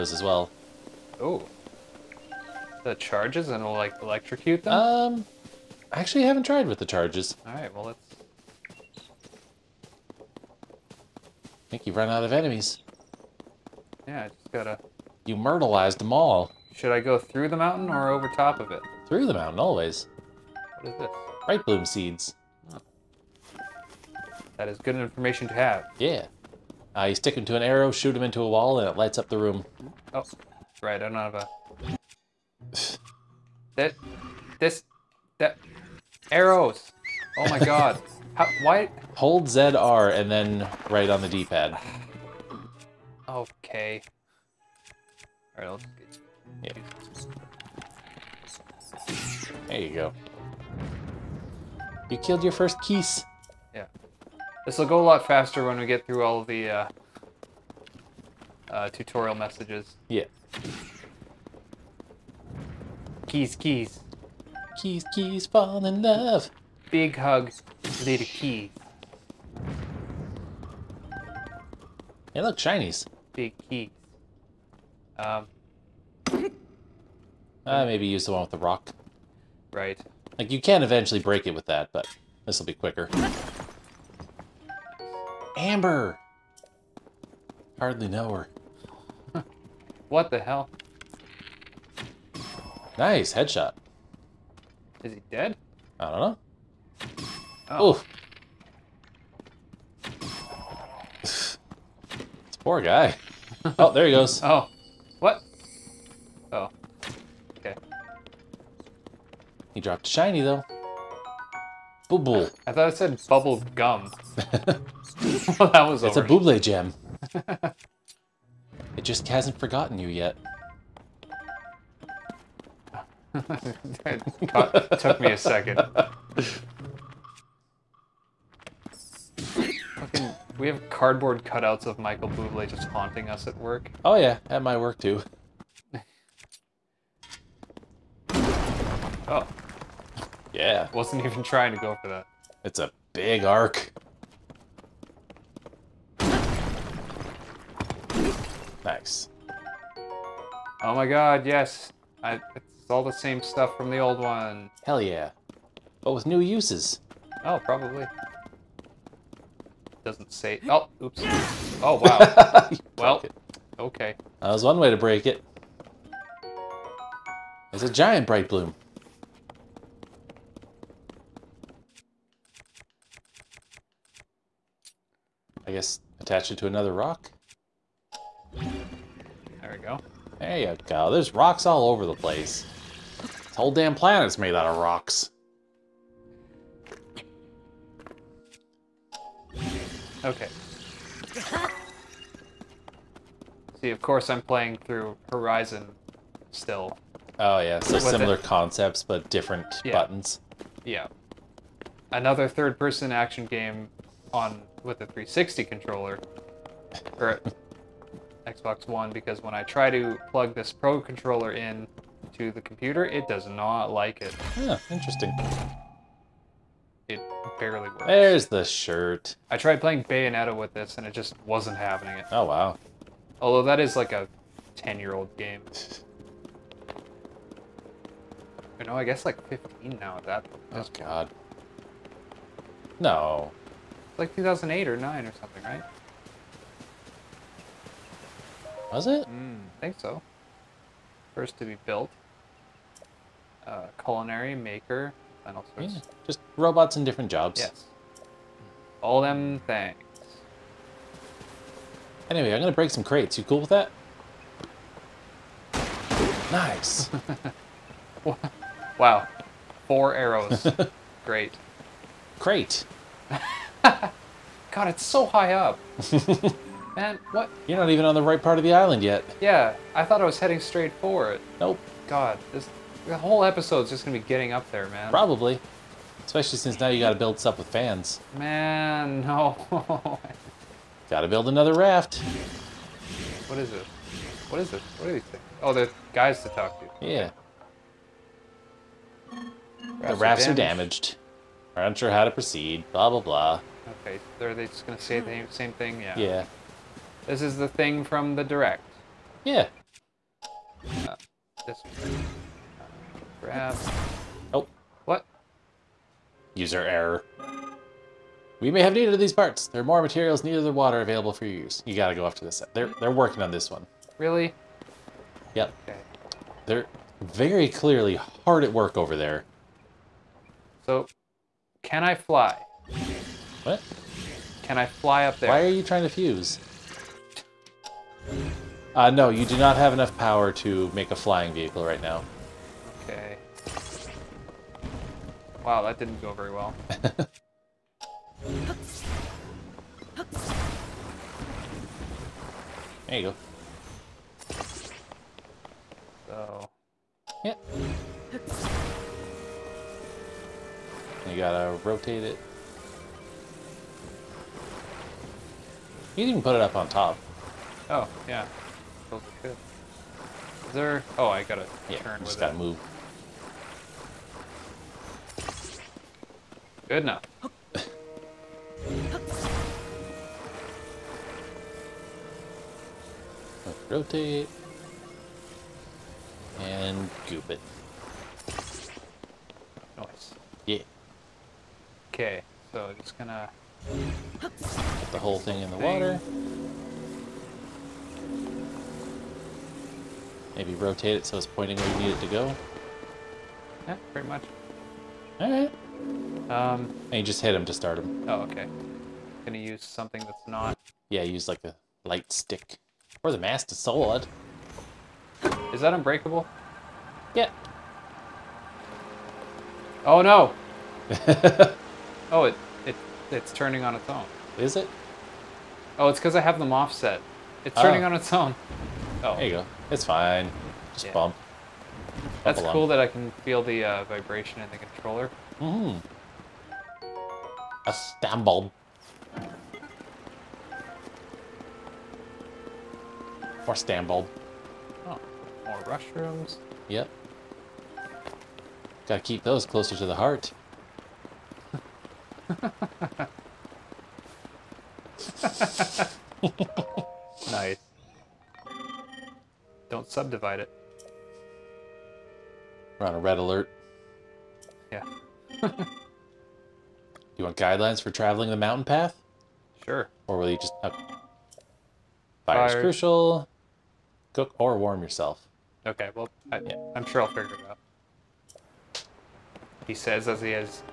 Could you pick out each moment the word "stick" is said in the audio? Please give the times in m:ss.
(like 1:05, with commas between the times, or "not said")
0:27, 6:42.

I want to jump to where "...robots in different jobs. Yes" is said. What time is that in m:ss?
4:06.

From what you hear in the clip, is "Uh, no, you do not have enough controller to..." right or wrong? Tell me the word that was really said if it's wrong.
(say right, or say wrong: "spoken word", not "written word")
wrong: "power", not "controller".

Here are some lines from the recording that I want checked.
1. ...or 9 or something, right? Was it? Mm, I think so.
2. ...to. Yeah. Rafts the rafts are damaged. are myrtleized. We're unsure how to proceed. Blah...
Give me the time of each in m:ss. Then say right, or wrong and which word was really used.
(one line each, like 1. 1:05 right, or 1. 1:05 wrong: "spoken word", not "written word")
1. 3:54 right
2. 4:46 wrong: "damaged", not "myrtleized".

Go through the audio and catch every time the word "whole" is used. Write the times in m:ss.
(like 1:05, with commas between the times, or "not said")
3:03, 4:33, 6:25.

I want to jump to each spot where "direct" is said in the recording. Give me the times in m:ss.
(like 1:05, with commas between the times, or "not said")
4:58.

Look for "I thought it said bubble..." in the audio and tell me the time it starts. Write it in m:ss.
1:52.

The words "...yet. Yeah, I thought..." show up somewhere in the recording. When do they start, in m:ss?
4:29.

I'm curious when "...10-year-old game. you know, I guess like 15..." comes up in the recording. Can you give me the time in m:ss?
3:44.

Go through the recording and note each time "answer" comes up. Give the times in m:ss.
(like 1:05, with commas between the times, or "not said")
not said.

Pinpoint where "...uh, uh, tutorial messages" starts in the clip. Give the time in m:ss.
0:56.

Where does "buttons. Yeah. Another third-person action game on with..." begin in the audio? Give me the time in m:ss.
3:19.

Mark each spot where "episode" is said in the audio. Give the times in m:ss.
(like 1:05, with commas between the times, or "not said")
4:33.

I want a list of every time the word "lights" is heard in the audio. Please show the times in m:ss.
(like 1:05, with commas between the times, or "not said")
0:28, 6:42.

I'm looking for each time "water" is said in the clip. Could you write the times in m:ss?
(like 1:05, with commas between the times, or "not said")
5:10, 6:25.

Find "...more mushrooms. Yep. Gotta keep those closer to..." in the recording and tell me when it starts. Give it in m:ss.
7:15.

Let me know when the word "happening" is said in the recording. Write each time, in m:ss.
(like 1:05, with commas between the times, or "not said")
3:41.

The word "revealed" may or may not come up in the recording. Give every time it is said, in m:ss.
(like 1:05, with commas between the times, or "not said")
not said.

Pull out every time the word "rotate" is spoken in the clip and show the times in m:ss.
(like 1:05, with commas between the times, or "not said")
5:51, 6:13, 6:30.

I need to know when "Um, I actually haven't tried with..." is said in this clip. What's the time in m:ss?
0:04.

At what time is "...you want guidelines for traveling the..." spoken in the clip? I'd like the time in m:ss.
7:37.